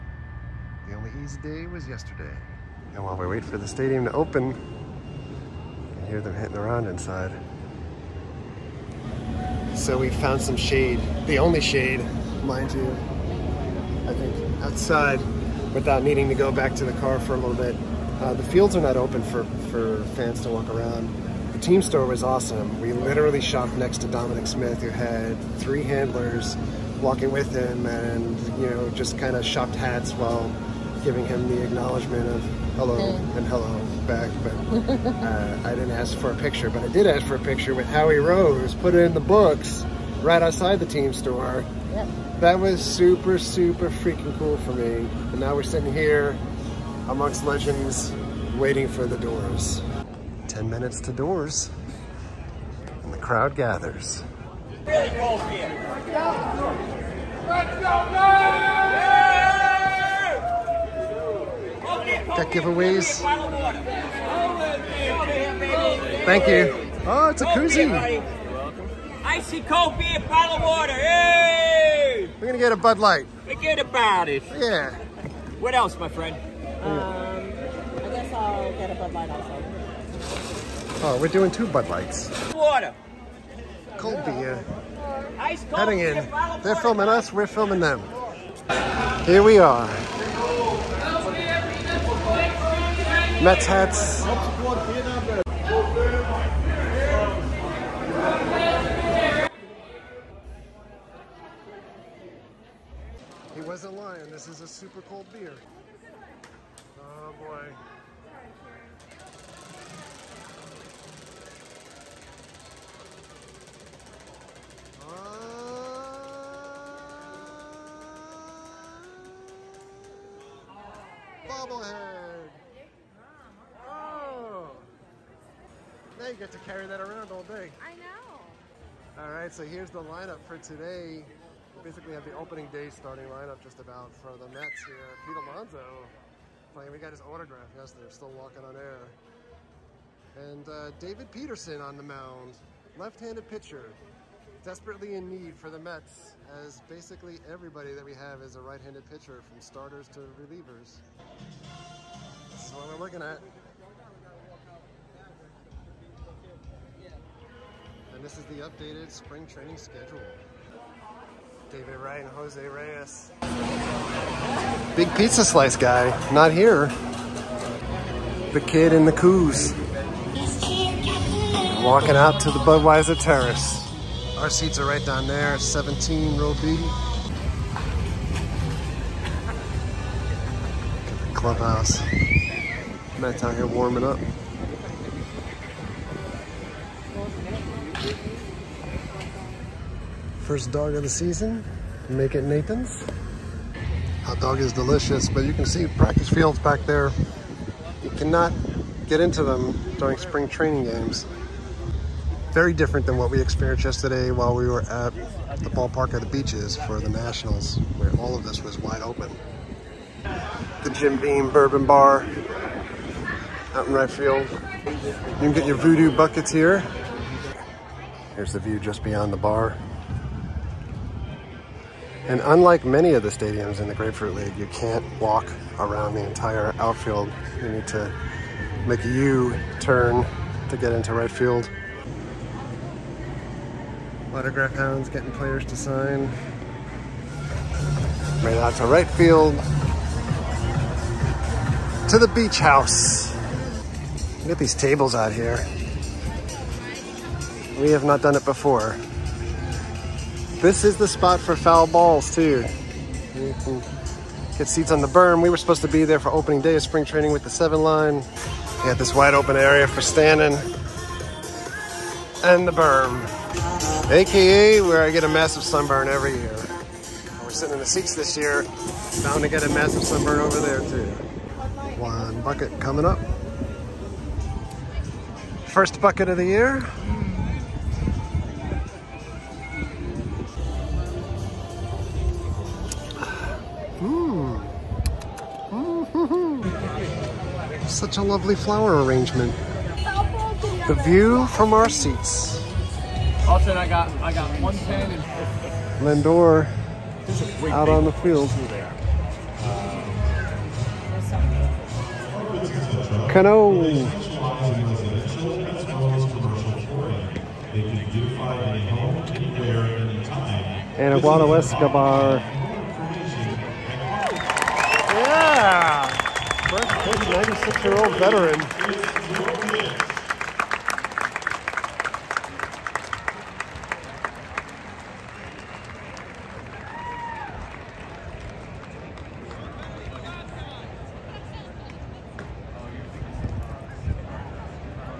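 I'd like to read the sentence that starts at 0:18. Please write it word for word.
Uh, the fields are not open for, for fans to walk around.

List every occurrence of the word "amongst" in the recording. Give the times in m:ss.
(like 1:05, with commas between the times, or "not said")
0:47.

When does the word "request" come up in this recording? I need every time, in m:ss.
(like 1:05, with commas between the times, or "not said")
not said.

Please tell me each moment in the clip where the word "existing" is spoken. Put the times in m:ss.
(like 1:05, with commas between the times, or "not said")
not said.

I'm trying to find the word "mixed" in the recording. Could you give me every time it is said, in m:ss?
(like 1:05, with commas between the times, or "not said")
not said.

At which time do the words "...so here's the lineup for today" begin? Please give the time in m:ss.
2:09.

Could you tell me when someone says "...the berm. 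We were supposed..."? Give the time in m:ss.
4:14.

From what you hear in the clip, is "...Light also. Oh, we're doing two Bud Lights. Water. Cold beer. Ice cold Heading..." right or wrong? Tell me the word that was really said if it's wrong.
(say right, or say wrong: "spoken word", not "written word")
right.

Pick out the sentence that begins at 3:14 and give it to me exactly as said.
Hot dog is delicious, but you can see practice fields back there.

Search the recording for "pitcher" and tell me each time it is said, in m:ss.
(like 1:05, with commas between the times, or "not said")
2:23, 2:29.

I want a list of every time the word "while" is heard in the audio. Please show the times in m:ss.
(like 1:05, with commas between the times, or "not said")
0:03, 0:30, 3:24.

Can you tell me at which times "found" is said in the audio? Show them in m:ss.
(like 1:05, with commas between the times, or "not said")
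0:10.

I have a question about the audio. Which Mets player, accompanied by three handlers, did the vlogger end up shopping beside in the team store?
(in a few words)
Dominic Smith.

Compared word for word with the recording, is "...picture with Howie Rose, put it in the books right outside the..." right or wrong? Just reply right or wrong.
right.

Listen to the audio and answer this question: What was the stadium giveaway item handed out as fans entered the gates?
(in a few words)
koozie.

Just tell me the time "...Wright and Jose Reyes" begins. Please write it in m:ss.
2:41.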